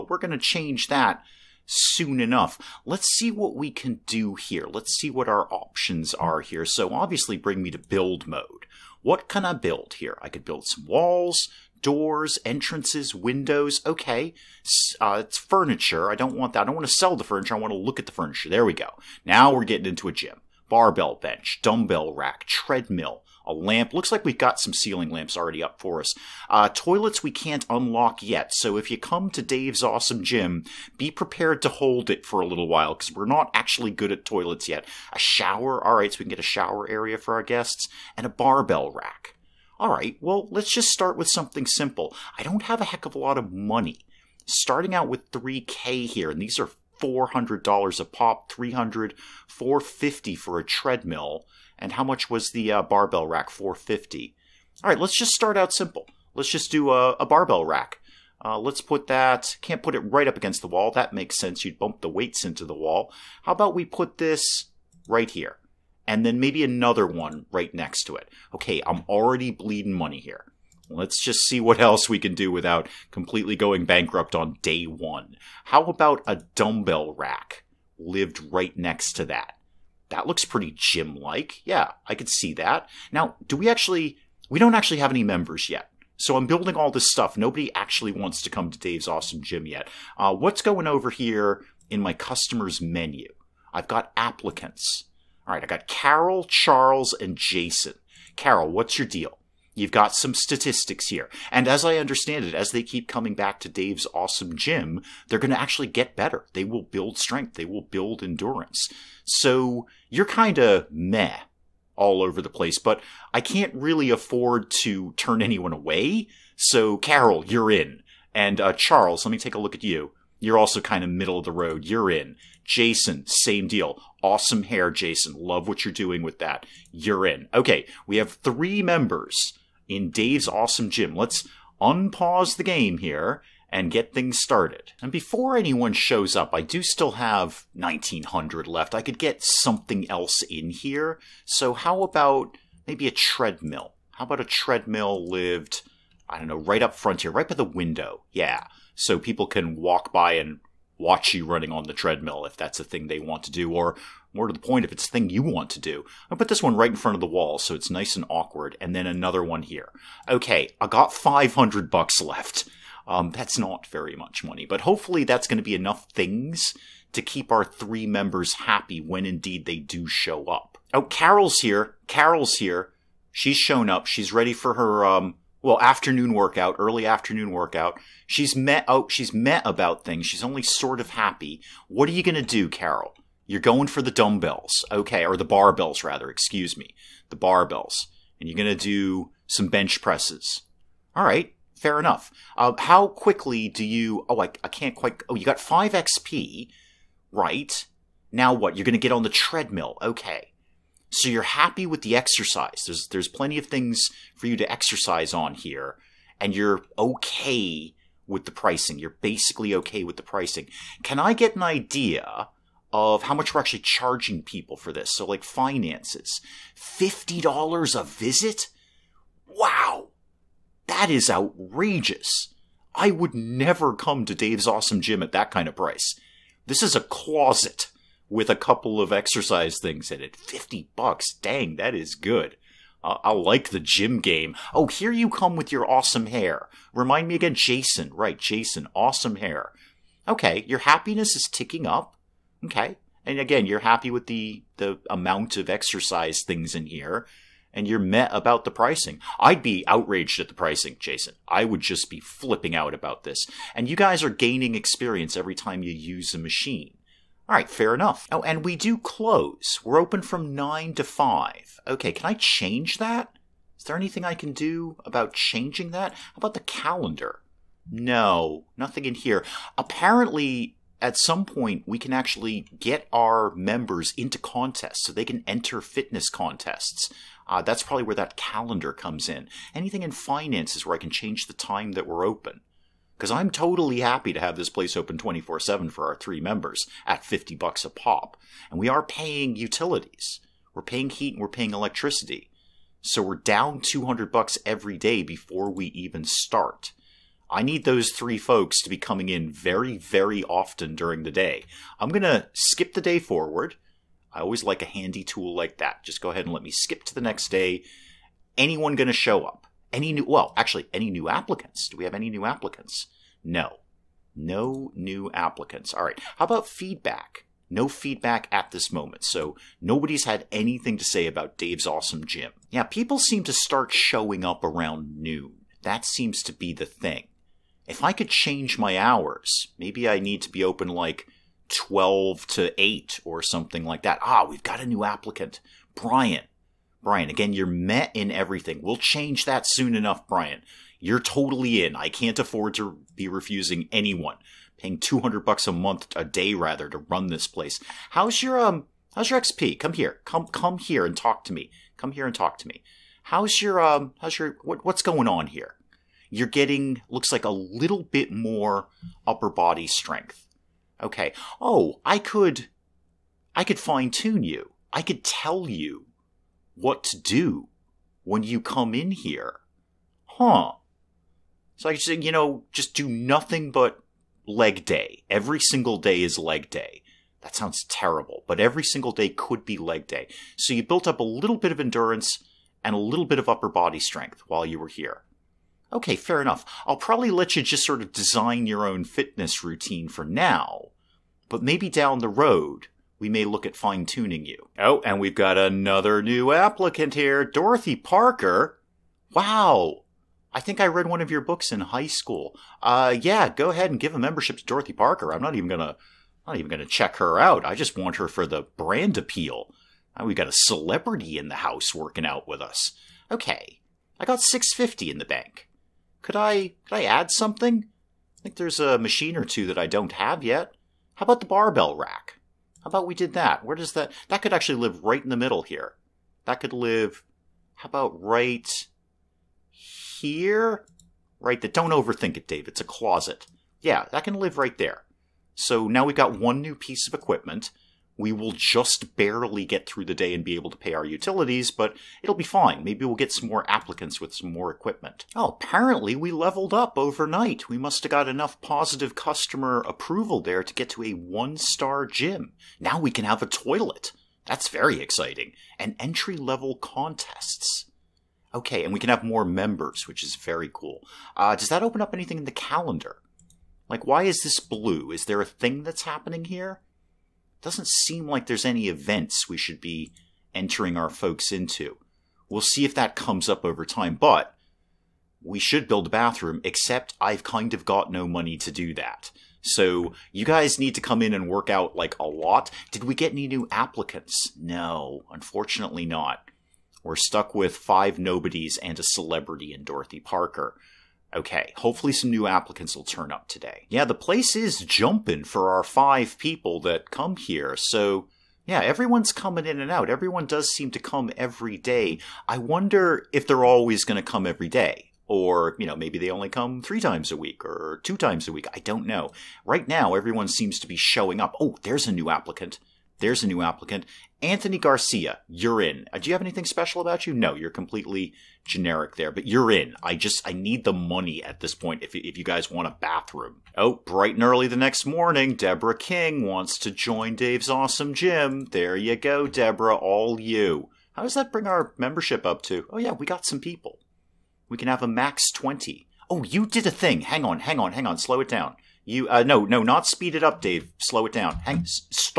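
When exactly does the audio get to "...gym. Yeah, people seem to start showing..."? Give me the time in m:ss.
5:22.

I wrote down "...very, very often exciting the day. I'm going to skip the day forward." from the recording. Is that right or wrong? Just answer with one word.
wrong.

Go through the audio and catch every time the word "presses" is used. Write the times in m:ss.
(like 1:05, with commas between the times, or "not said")
3:10.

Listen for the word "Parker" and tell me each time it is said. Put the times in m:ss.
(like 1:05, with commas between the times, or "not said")
6:37, 6:44, 8:10.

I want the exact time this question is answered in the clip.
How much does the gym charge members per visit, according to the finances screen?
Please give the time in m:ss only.
3:36.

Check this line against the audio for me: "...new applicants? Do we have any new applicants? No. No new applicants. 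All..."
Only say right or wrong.
right.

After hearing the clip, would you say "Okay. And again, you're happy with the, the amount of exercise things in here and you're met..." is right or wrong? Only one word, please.
right.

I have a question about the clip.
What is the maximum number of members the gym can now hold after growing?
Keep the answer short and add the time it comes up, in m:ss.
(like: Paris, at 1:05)
20, at 8:55.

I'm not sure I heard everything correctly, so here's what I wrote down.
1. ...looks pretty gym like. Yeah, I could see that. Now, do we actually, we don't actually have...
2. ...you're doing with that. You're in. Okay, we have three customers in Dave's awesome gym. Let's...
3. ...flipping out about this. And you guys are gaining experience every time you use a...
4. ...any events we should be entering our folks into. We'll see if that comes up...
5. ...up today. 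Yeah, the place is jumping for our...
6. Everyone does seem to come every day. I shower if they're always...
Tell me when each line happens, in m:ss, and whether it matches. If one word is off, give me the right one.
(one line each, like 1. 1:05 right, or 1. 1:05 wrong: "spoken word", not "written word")
1. 1:20 right
2. 2:05 wrong: "members", not "customers"
3. 4:12 right
4. 7:48 right
5. 8:13 right
6. 8:20 wrong: "wonder", not "shower".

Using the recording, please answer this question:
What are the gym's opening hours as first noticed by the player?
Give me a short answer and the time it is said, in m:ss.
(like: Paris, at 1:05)
9 to 5, at 4:20.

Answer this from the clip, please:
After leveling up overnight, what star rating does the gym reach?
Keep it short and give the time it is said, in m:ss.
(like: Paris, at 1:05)
one-star, at 7:31.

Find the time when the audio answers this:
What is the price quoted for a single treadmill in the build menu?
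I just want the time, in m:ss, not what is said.
0:49.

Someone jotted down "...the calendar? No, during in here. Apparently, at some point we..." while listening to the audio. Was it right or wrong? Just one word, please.
wrong.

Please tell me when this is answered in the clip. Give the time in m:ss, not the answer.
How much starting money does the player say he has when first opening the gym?
0:45.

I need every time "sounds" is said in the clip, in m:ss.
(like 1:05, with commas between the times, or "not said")
6:17.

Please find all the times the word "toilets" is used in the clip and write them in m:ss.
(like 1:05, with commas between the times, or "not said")
0:26, 0:34, 7:33.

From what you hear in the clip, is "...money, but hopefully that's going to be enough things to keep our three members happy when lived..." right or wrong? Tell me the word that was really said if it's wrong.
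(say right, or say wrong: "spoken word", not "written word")
wrong: "indeed", not "lived".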